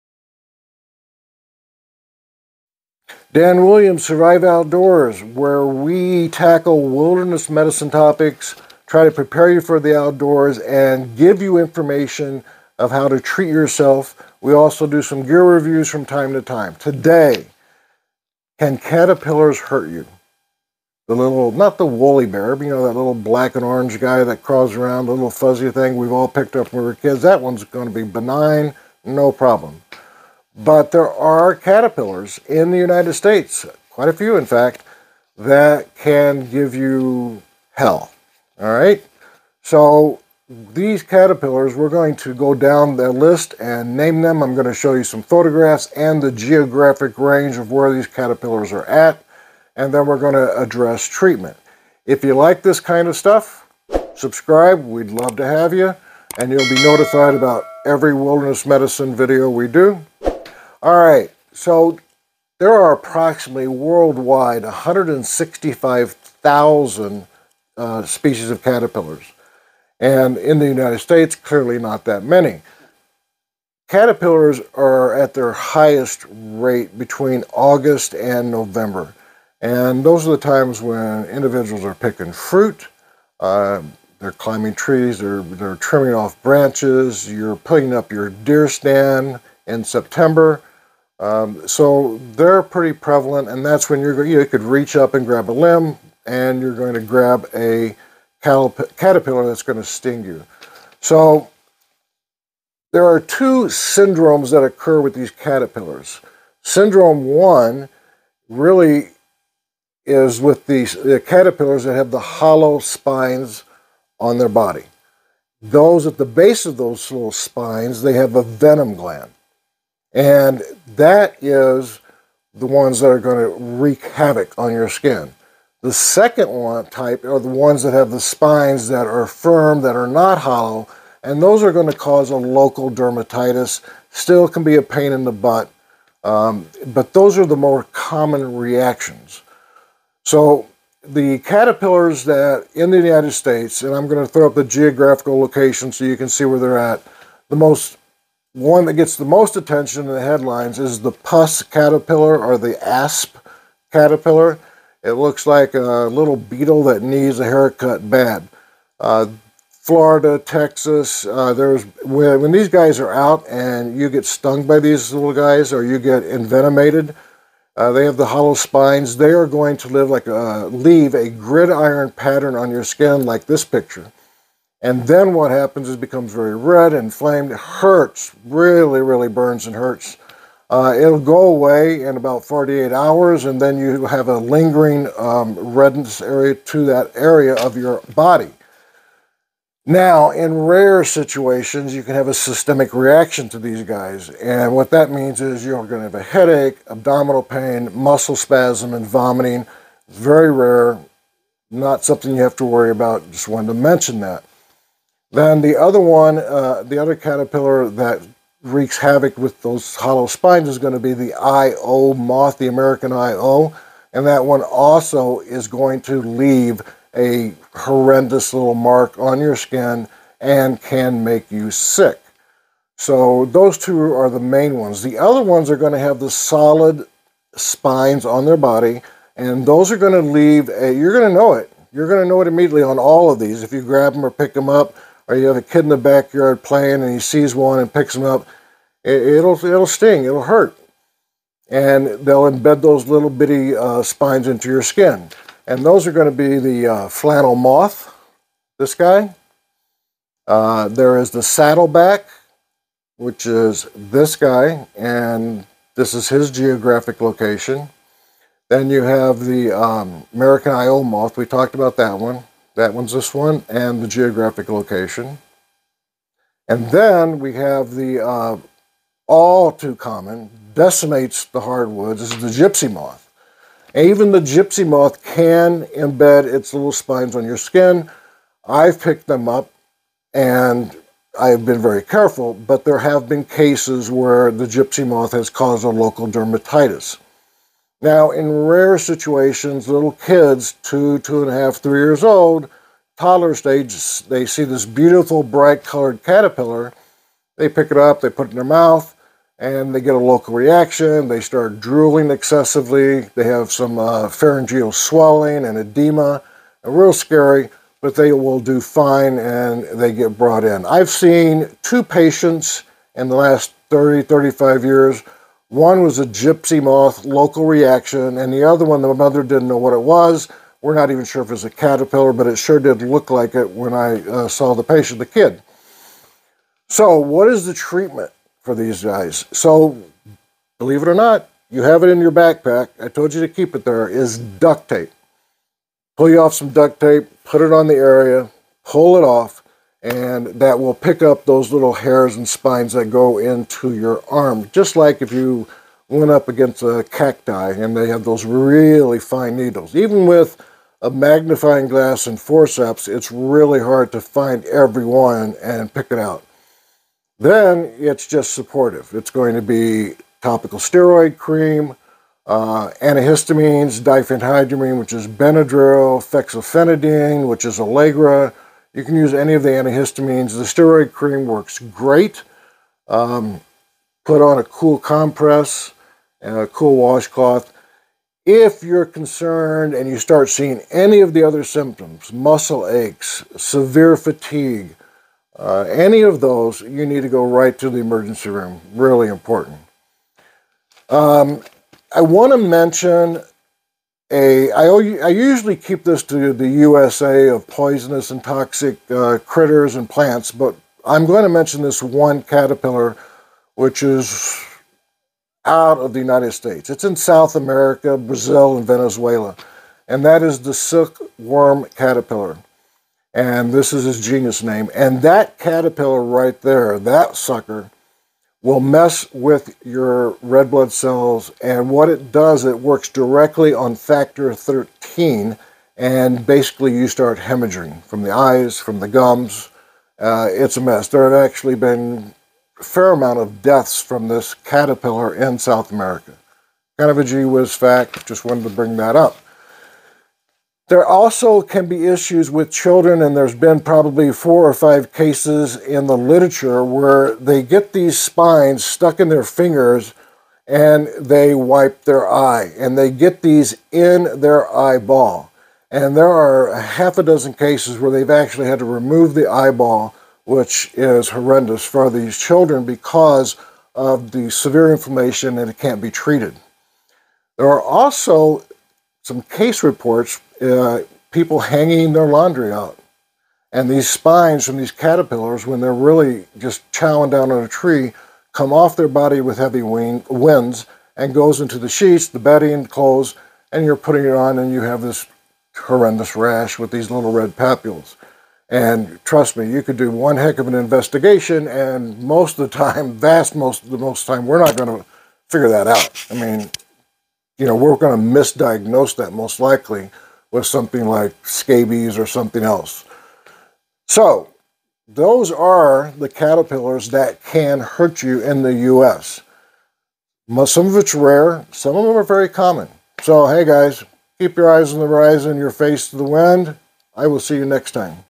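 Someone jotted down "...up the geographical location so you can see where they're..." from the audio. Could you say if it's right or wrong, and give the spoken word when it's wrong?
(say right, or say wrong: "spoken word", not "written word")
right.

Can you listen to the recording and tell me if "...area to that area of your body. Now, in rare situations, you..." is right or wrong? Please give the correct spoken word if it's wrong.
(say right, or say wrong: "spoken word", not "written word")
right.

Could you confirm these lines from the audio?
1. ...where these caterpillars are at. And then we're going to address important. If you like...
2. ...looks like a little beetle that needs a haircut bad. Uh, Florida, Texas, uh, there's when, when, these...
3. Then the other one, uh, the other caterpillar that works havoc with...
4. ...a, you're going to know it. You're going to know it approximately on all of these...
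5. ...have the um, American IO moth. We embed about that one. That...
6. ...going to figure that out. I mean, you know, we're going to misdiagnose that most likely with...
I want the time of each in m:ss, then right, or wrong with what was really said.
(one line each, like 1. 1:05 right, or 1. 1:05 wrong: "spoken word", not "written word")
1. 0:47 wrong: "treatment", not "important"
2. 2:35 right
3. 3:25 wrong: "wreaks", not "works"
4. 3:50 wrong: "immediately", not "approximately"
5. 4:19 wrong: "talked", not "embed"
6. 8:14 right.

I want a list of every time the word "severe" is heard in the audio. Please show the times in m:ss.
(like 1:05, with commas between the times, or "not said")
6:23, 7:44.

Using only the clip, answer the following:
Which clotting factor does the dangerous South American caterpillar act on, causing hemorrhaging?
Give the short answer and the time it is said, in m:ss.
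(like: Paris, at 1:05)
factor 13, at 7:03.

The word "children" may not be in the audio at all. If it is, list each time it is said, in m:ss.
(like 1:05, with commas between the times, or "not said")
7:22, 7:42.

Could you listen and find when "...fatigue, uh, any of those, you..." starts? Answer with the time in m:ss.
6:24.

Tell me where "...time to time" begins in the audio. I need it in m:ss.
0:16.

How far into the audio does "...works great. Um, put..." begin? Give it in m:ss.
6:11.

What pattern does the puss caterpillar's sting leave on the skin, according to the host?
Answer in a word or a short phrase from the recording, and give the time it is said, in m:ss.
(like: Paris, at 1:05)
gridiron pattern, at 2:51.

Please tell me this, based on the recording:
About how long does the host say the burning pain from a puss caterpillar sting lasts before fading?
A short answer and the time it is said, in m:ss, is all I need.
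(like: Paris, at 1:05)
48 hours, at 3:02.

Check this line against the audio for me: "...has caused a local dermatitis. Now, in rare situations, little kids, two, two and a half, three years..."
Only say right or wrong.
right.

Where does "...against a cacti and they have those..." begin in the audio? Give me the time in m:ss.
5:46.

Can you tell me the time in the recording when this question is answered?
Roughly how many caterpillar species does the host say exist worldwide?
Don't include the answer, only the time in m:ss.
1:04.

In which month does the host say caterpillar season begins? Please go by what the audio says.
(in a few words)
August.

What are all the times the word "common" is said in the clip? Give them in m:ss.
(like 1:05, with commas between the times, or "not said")
2:17, 4:29, 8:32.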